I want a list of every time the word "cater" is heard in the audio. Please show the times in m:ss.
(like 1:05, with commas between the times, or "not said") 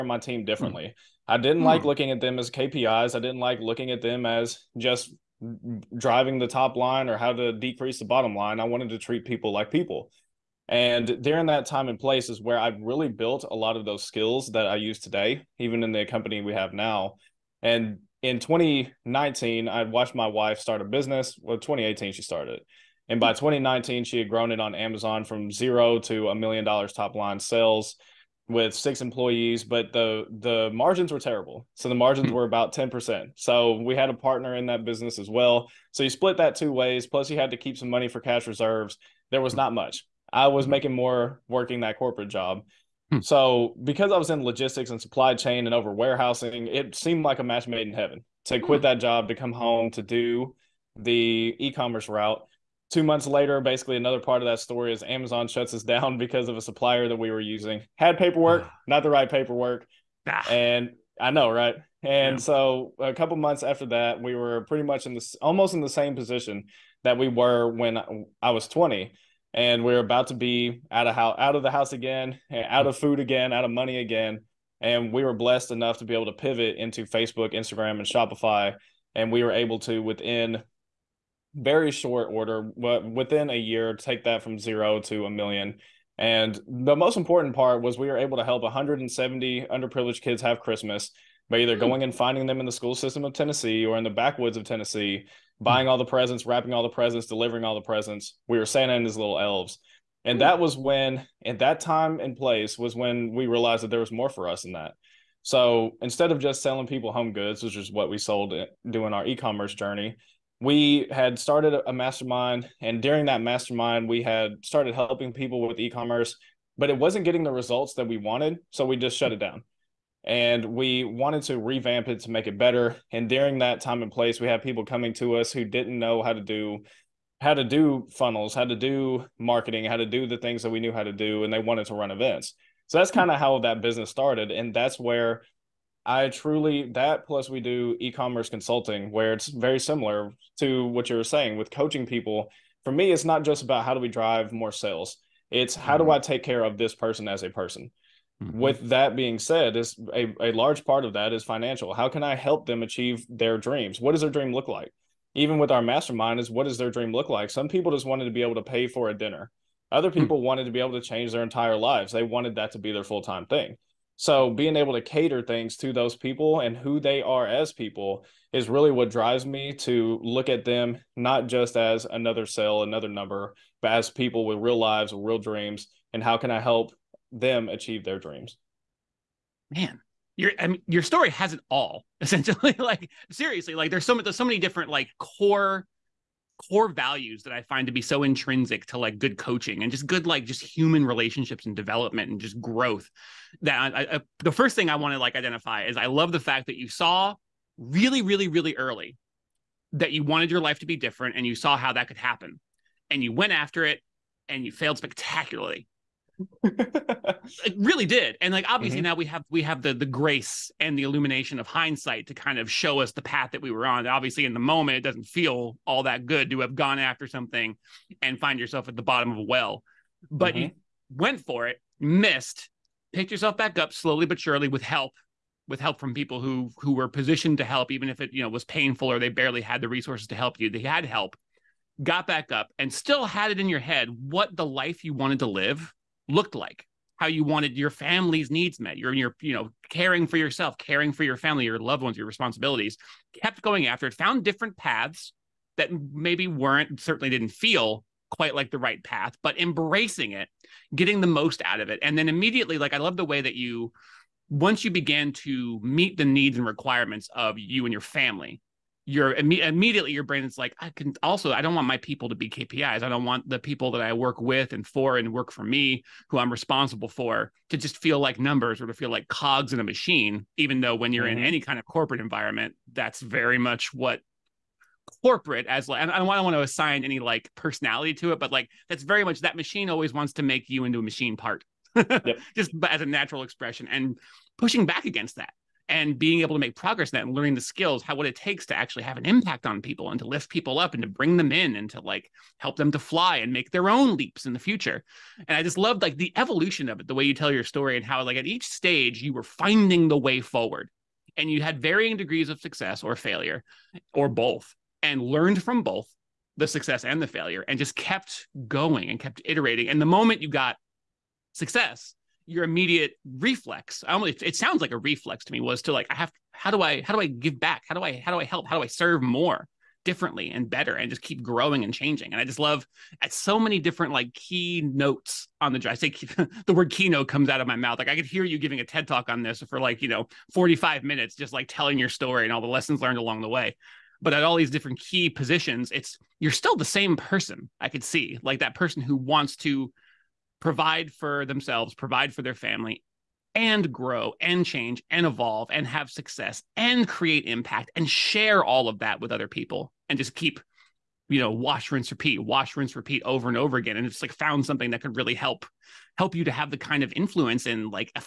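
2:45.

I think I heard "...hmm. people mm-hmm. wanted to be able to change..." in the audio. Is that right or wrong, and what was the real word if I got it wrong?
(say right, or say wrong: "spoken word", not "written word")
right.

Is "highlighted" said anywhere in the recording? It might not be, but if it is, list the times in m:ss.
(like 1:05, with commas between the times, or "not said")
not said.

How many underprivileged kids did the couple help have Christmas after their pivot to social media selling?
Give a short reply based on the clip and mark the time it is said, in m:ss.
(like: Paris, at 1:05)
170, at 1:28.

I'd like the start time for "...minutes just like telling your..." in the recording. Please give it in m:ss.
5:31.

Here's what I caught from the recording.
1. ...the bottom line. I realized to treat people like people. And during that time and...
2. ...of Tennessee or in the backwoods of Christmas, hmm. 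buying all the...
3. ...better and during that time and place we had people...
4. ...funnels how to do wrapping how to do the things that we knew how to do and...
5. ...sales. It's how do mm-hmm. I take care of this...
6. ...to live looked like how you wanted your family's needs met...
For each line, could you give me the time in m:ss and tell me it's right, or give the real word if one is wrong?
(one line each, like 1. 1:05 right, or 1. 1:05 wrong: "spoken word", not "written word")
1. 0:07 wrong: "wanted", not "realized"
2. 1:33 wrong: "Tennessee", not "Christmas"
3. 2:02 right
4. 2:08 wrong: "marketing", not "wrapping"
5. 2:24 right
6. 3:55 right.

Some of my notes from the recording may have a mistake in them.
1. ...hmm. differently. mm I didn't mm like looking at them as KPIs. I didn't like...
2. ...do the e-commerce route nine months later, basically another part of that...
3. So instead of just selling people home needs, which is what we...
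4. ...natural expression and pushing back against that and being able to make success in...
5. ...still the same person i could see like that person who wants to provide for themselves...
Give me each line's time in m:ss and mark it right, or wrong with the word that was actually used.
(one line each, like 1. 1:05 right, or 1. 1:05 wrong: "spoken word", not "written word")
1. 0:00 right
2. 0:50 wrong: "two", not "nine"
3. 1:45 wrong: "goods", not "needs"
4. 4:43 wrong: "progress", not "success"
5. 5:36 right.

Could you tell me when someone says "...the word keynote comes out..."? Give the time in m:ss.
5:26.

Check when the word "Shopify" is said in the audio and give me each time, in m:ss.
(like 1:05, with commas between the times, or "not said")
1:18.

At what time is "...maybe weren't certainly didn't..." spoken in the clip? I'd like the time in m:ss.
4:06.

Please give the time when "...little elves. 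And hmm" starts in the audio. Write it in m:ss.
1:39.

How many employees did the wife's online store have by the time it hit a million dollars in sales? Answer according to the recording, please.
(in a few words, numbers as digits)
6.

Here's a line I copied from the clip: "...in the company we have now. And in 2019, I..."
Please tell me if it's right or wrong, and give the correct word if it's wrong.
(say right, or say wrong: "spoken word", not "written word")
right.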